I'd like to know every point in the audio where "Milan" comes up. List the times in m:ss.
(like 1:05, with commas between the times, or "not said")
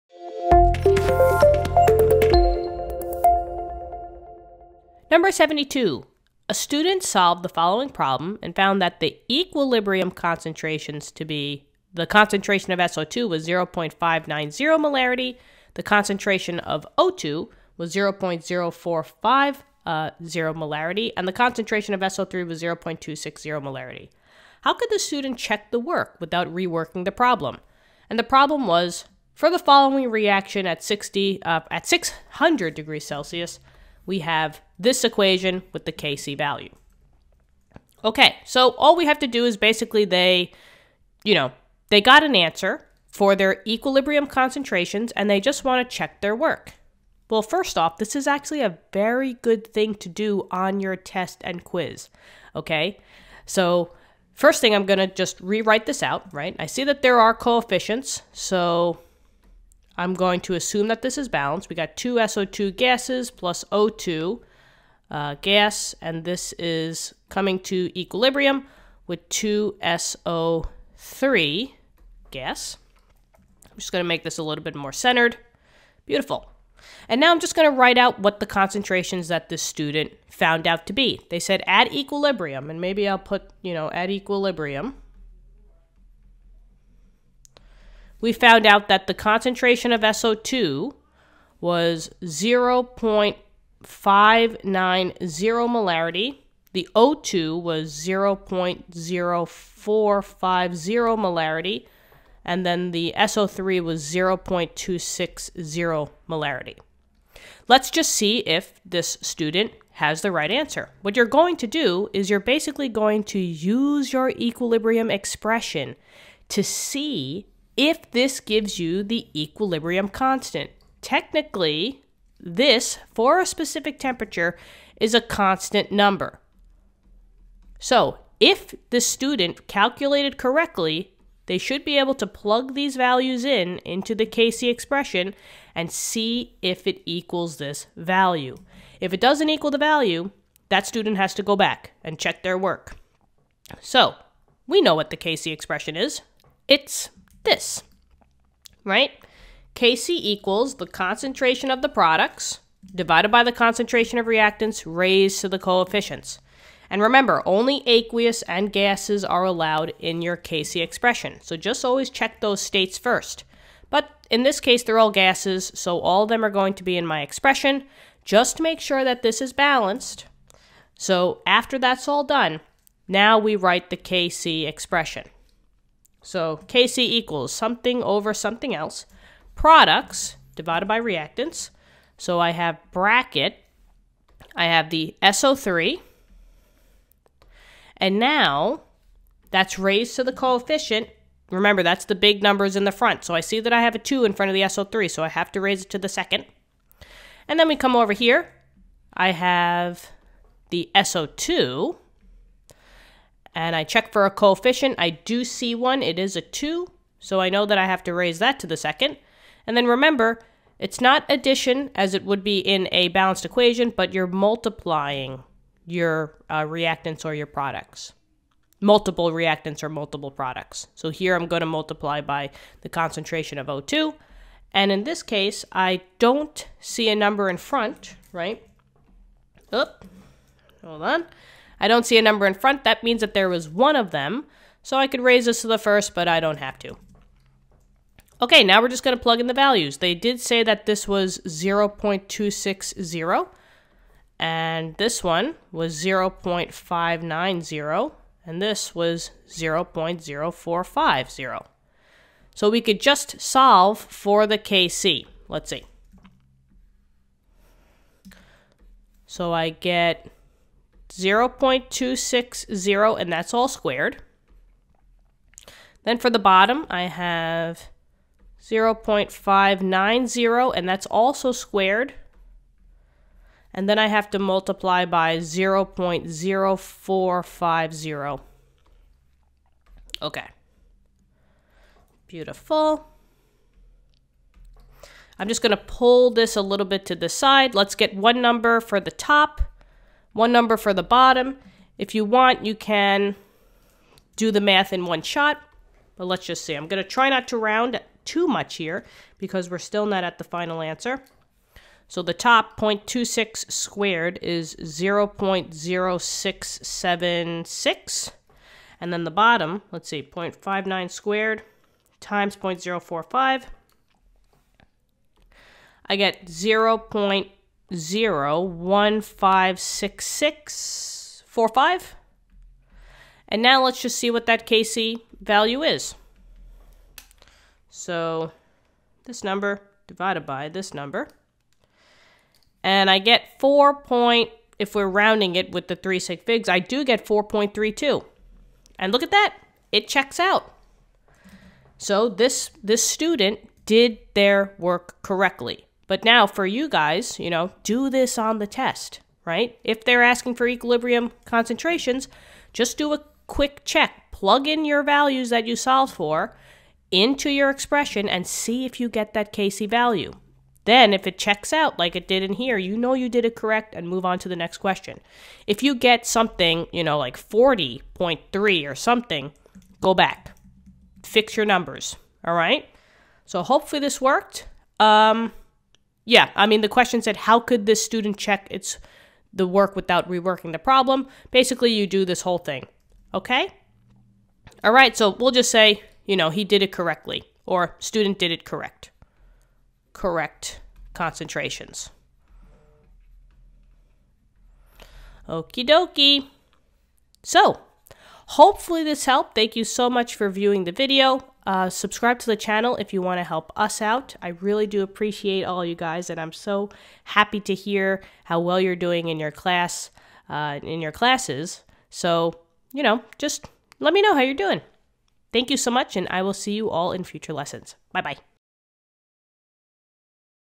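not said.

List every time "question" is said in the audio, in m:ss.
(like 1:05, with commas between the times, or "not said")
6:04, 6:16.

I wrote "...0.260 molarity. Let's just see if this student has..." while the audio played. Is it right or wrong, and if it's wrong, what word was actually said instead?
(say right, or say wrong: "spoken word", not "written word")
right.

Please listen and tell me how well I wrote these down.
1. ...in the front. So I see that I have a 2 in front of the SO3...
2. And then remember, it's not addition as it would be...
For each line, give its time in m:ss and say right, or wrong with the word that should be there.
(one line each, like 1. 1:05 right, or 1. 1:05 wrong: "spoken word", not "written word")
1. 3:12 right
2. 3:29 right.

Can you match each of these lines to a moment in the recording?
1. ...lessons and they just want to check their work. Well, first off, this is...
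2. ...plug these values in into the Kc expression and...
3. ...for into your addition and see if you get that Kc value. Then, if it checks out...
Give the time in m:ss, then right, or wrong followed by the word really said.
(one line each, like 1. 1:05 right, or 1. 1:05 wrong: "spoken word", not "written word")
1. 0:44 wrong: "concentrations", not "lessons"
2. 2:12 right
3. 5:56 wrong: "expression", not "addition".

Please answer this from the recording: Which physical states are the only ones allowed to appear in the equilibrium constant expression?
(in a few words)
aqueous and gases.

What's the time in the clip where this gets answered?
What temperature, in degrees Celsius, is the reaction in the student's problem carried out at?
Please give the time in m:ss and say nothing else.
0:31.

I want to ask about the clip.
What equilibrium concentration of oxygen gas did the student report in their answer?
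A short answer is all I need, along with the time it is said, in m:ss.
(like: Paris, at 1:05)
0.0450 M, at 1:37.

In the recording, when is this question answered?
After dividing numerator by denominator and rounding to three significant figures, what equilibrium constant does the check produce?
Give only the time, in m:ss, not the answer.
5:37.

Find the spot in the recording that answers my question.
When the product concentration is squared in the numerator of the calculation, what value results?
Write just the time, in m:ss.
5:05.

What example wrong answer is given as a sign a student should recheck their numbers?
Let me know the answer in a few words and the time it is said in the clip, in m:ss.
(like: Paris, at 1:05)
40.3, at 6:07.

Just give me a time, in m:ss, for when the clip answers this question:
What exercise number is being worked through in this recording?
0:05.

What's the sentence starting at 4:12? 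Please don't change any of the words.
So we could just solve for the KC.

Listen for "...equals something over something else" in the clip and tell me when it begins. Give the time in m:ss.
2:56.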